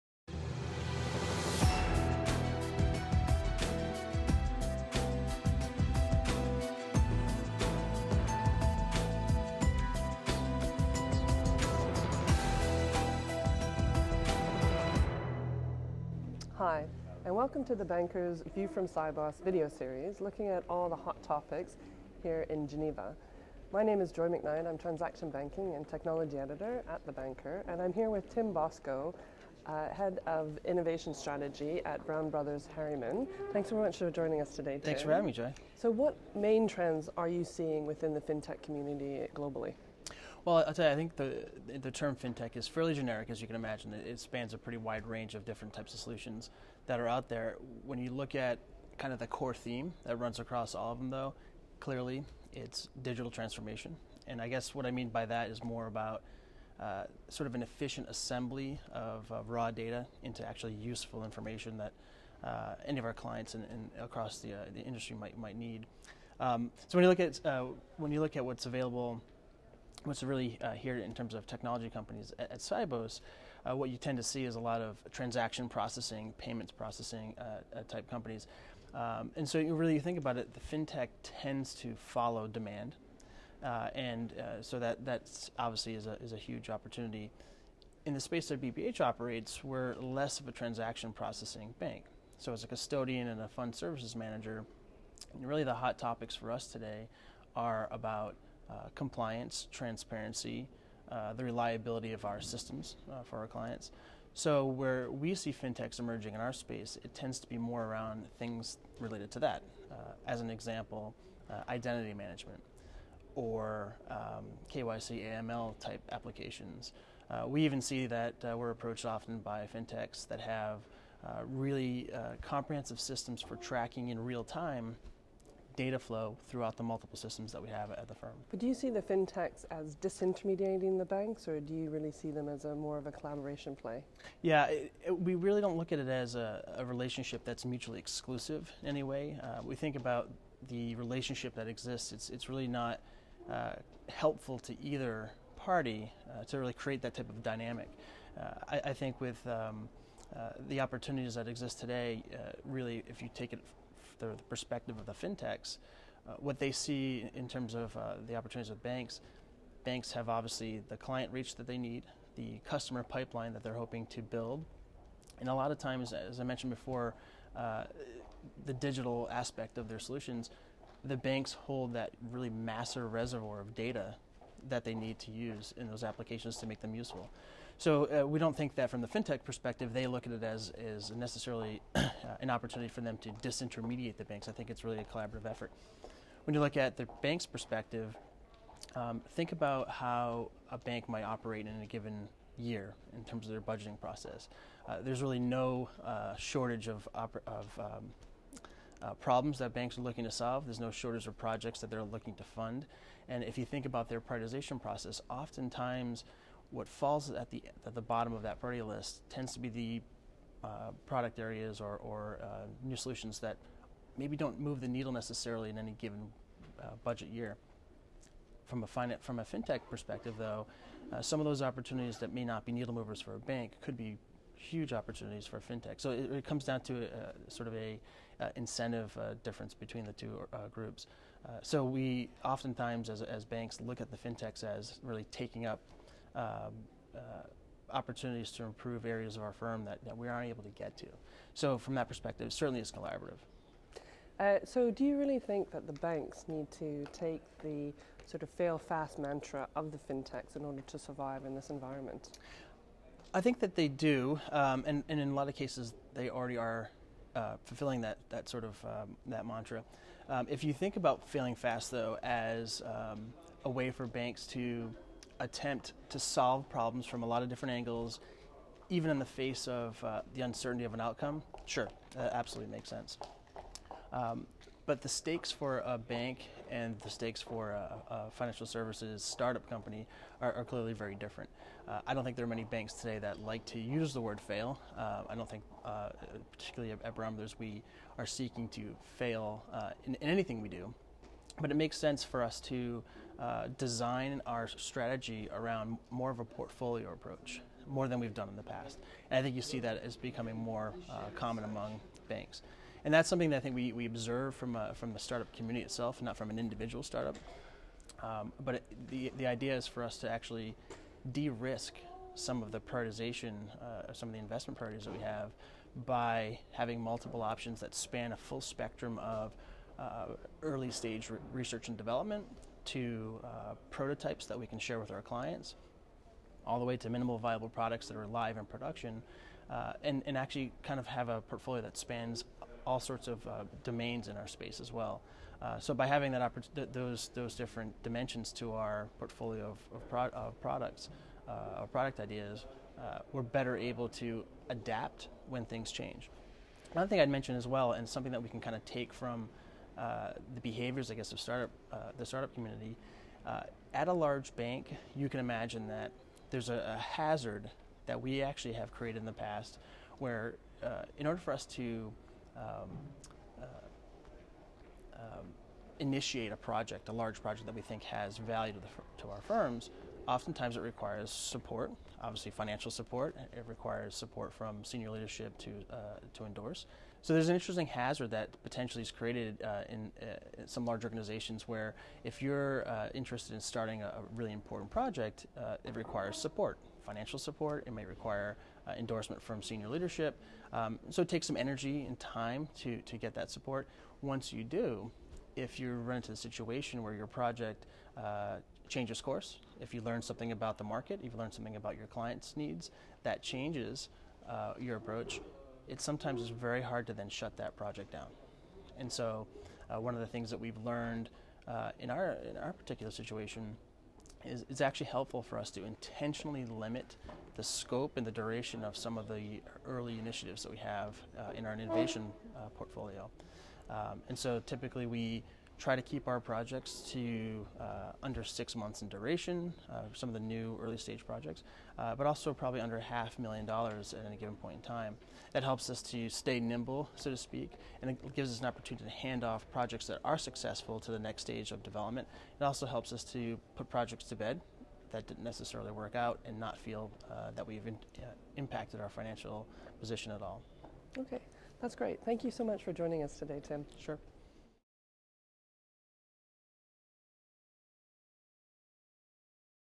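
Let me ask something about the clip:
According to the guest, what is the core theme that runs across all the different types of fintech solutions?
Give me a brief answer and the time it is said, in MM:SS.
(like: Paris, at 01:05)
Digital transformation, at 00:53.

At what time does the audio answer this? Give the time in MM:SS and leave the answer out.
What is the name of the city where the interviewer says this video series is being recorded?
00:22.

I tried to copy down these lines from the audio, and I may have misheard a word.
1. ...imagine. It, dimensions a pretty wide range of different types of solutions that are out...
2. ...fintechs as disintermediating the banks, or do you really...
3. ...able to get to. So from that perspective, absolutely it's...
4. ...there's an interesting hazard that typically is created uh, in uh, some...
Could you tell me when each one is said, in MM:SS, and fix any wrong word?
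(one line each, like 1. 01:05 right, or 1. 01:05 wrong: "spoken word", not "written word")
1. 00:43 wrong: "spans", not "dimensions"
2. 02:09 right
3. 04:00 wrong: "certainly", not "absolutely"
4. 06:17 wrong: "potentially", not "typically".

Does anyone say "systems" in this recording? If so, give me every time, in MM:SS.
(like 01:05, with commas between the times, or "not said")
01:42, 02:02, 02:07.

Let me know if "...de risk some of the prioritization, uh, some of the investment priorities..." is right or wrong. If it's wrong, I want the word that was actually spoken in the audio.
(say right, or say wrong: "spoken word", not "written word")
right.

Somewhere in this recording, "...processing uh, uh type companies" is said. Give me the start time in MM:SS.
01:16.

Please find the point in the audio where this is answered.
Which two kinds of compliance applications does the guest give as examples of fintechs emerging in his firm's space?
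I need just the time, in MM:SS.
01:54.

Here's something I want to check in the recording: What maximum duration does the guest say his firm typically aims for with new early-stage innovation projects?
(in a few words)
Under 6 months.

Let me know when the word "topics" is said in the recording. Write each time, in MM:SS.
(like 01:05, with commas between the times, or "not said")
00:21, 01:35.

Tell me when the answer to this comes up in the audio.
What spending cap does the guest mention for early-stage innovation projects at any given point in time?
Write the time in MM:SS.
07:12.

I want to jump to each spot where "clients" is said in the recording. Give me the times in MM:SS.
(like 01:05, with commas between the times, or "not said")
01:03, 01:43, 02:40, 05:25, 06:42.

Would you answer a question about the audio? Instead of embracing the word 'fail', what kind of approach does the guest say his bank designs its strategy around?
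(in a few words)
Portfolio approach.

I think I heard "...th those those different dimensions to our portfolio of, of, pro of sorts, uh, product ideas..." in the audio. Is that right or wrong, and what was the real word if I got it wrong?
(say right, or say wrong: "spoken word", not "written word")
wrong: "products", not "sorts".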